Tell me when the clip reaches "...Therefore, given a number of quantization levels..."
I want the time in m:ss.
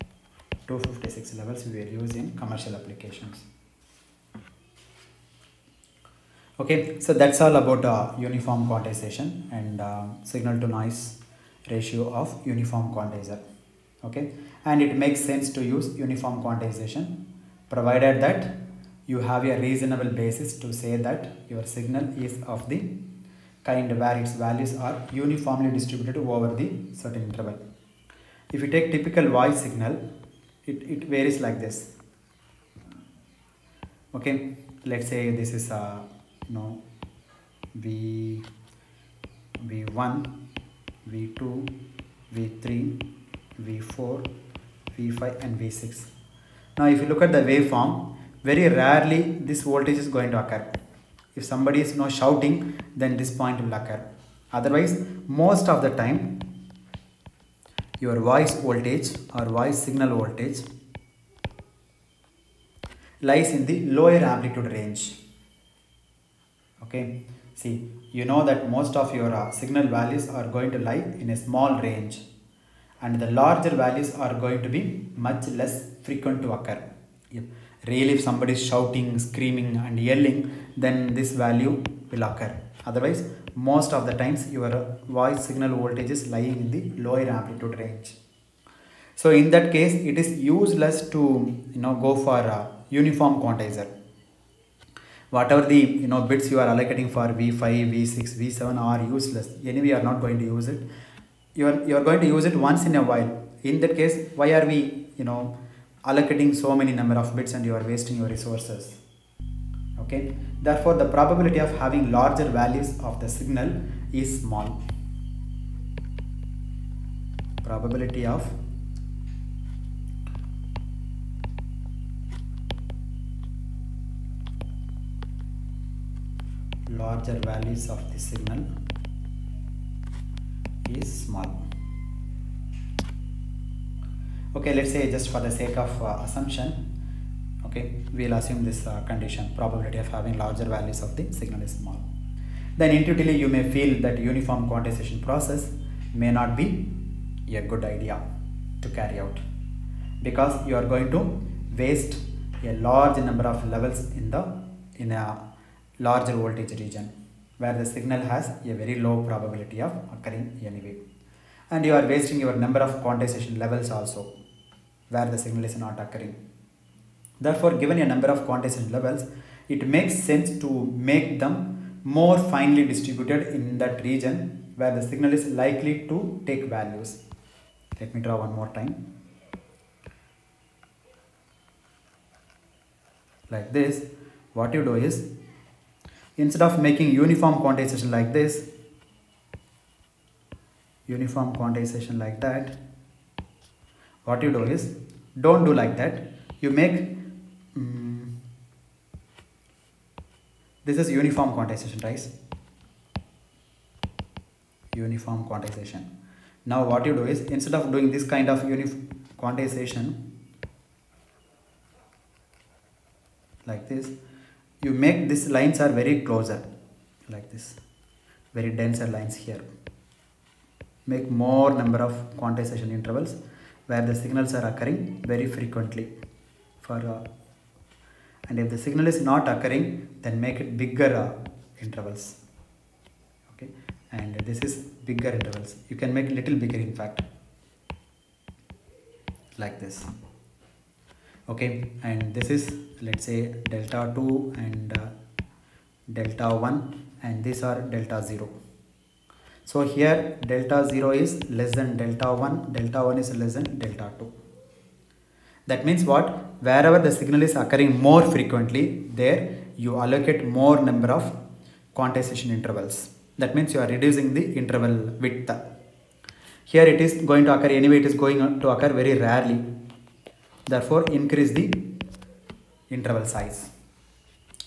2:47.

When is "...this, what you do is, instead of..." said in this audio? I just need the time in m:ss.
3:03.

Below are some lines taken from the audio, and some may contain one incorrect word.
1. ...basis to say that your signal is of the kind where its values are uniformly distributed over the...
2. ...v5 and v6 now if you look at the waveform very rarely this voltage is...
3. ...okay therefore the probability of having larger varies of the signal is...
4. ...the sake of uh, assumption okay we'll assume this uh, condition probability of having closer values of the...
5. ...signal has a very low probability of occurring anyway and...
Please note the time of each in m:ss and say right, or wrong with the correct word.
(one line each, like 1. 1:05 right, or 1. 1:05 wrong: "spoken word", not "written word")
1. 0:20 right
2. 0:44 right
3. 1:49 wrong: "values", not "varies"
4. 2:15 wrong: "larger", not "closer"
5. 2:37 right.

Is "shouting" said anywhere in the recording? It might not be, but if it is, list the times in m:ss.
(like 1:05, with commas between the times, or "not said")
0:52, 1:18.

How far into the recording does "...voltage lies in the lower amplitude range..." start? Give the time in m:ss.
1:00.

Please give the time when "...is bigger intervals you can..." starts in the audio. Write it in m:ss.
3:54.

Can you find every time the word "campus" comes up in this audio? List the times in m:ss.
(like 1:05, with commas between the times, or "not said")
not said.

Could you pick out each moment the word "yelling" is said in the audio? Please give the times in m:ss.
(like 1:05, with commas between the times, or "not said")
1:20.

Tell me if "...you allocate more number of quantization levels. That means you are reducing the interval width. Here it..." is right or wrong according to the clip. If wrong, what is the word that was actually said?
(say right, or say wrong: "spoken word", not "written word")
wrong: "intervals", not "levels".